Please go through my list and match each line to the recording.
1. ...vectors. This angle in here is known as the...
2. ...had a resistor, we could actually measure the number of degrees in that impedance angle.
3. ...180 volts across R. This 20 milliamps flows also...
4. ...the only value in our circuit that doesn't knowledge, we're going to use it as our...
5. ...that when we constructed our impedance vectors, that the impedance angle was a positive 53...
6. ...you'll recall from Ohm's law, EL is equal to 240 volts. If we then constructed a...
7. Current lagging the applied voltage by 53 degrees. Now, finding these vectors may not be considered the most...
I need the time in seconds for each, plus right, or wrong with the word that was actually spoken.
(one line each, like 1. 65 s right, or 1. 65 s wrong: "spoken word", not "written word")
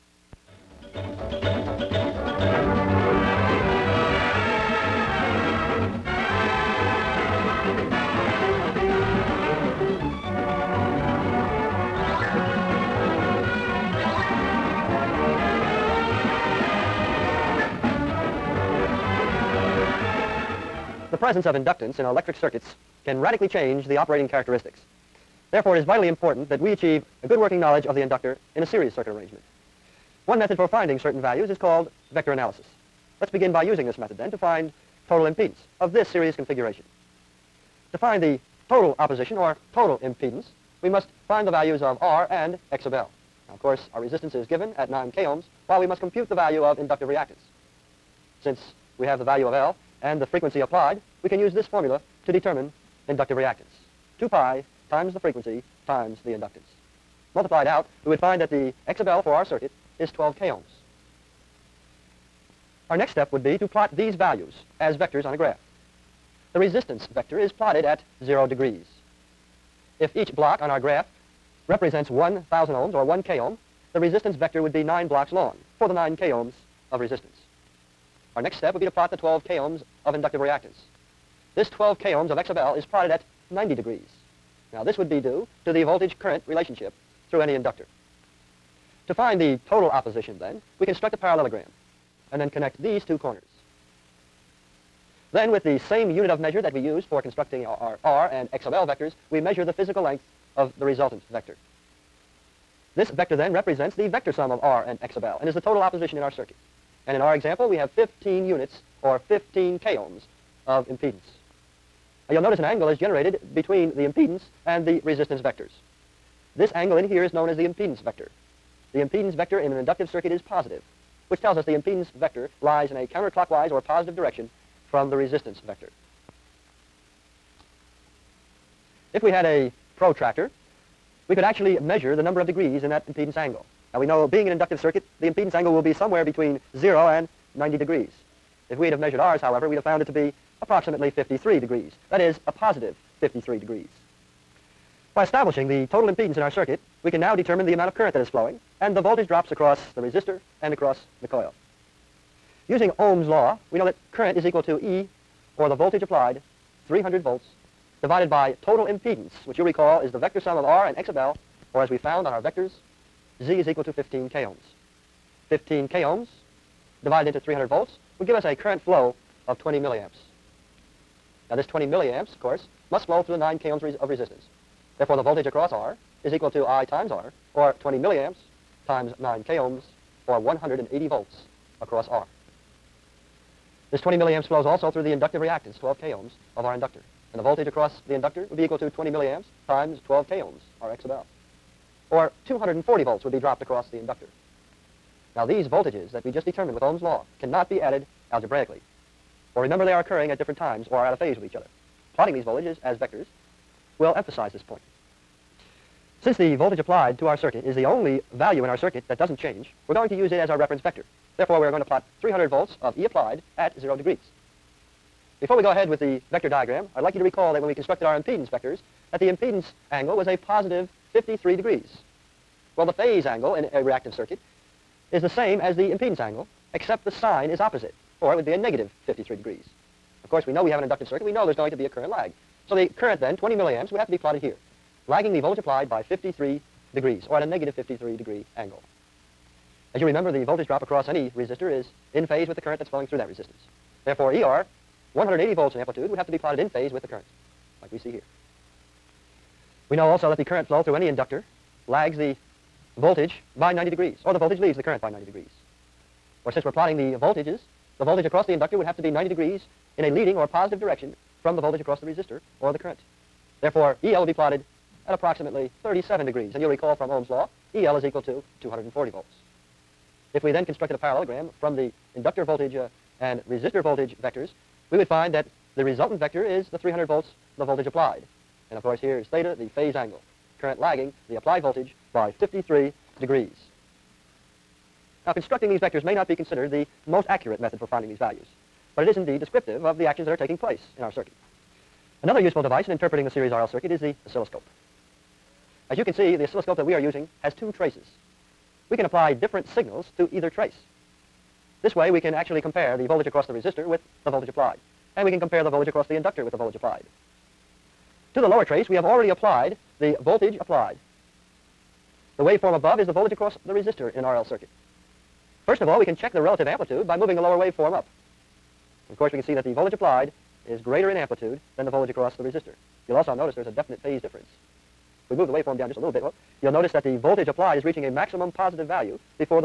1. 115 s right
2. 129 s wrong: "protractor", not "resistor"
3. 180 s right
4. 207 s wrong: "change", not "knowledge"
5. 217 s right
6. 266 s right
7. 280 s wrong: "constructing", not "finding".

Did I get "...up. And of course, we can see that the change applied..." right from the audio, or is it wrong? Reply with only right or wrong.
wrong.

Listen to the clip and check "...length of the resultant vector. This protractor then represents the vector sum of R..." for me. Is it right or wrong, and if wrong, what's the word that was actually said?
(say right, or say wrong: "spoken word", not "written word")
wrong: "vector", not "protractor".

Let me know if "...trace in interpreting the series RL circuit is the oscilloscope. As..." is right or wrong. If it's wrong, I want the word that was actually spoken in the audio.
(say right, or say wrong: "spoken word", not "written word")
wrong: "device", not "trace".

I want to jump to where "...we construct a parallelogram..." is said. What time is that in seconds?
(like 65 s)
90 s.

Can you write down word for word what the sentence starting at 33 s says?
Let's begin by using this method then to find total impedance of this series configuration.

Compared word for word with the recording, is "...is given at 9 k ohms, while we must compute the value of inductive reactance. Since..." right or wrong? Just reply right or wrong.
right.